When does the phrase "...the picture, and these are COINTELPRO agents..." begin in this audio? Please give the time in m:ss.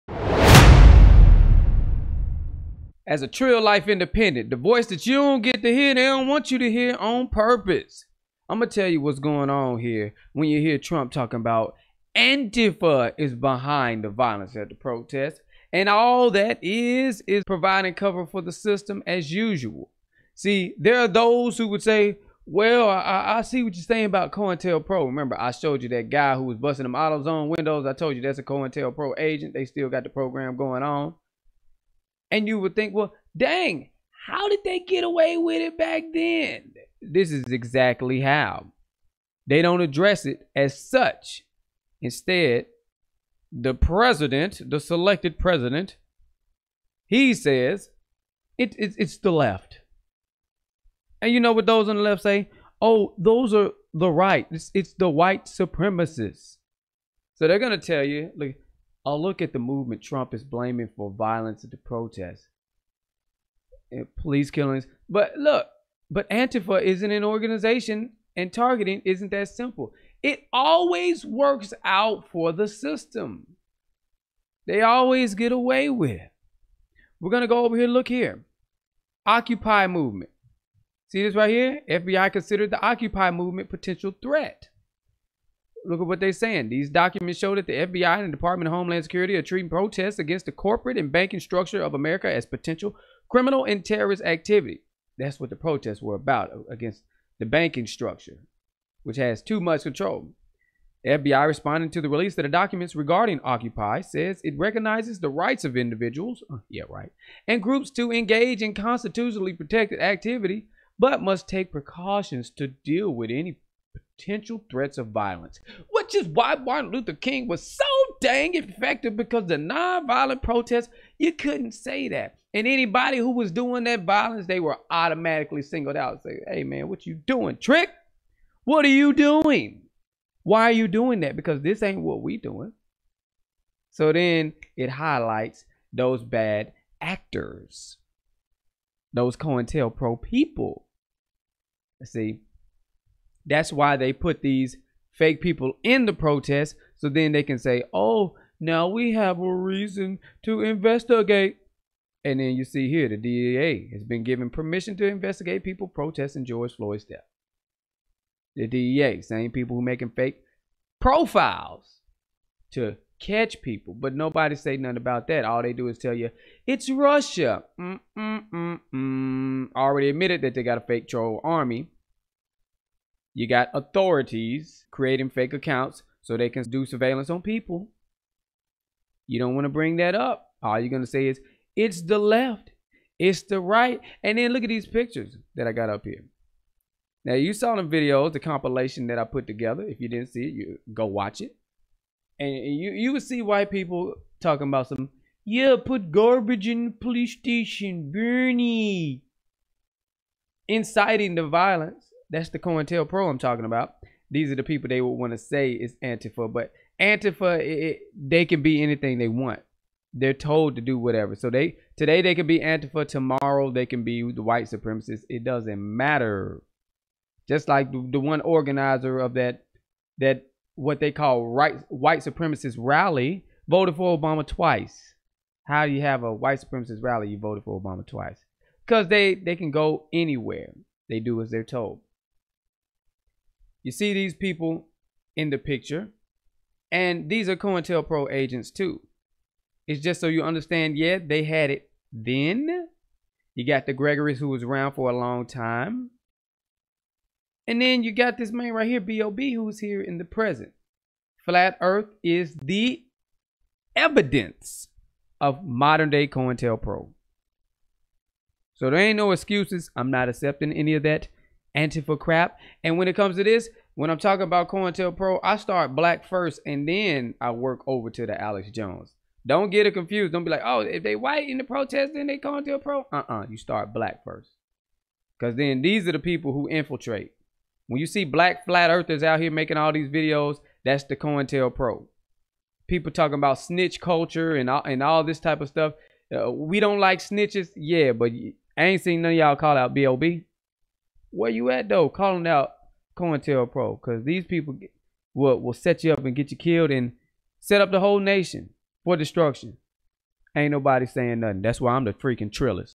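3:55.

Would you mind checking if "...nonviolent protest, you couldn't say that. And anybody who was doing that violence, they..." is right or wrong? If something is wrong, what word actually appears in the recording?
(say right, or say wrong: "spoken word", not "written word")
right.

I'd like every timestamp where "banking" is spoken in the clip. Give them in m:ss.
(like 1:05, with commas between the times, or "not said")
1:31, 1:37.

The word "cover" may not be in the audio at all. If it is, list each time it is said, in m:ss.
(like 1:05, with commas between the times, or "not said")
0:17.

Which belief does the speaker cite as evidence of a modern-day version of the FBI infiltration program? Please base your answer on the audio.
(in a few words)
Flat Earth.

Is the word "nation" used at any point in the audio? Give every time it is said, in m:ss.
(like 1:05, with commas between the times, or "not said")
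4:58.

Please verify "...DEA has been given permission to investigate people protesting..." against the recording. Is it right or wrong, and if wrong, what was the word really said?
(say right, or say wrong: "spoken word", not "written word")
right.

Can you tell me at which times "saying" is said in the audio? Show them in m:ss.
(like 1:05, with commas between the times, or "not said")
0:23, 1:26, 5:01.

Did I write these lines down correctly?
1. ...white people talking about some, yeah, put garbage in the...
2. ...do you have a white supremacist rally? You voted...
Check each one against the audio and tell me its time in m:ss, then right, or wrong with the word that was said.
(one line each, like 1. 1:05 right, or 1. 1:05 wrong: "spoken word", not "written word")
1. 3:13 right
2. 3:45 right.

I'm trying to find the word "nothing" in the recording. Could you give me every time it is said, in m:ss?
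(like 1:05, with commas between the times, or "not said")
2:44, 5:01.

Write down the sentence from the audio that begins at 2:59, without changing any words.
You don't want to bring that up.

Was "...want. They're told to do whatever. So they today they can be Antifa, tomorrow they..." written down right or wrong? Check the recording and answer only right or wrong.
right.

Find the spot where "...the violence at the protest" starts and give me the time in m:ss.
0:14.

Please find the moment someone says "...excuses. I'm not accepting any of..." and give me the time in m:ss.
4:19.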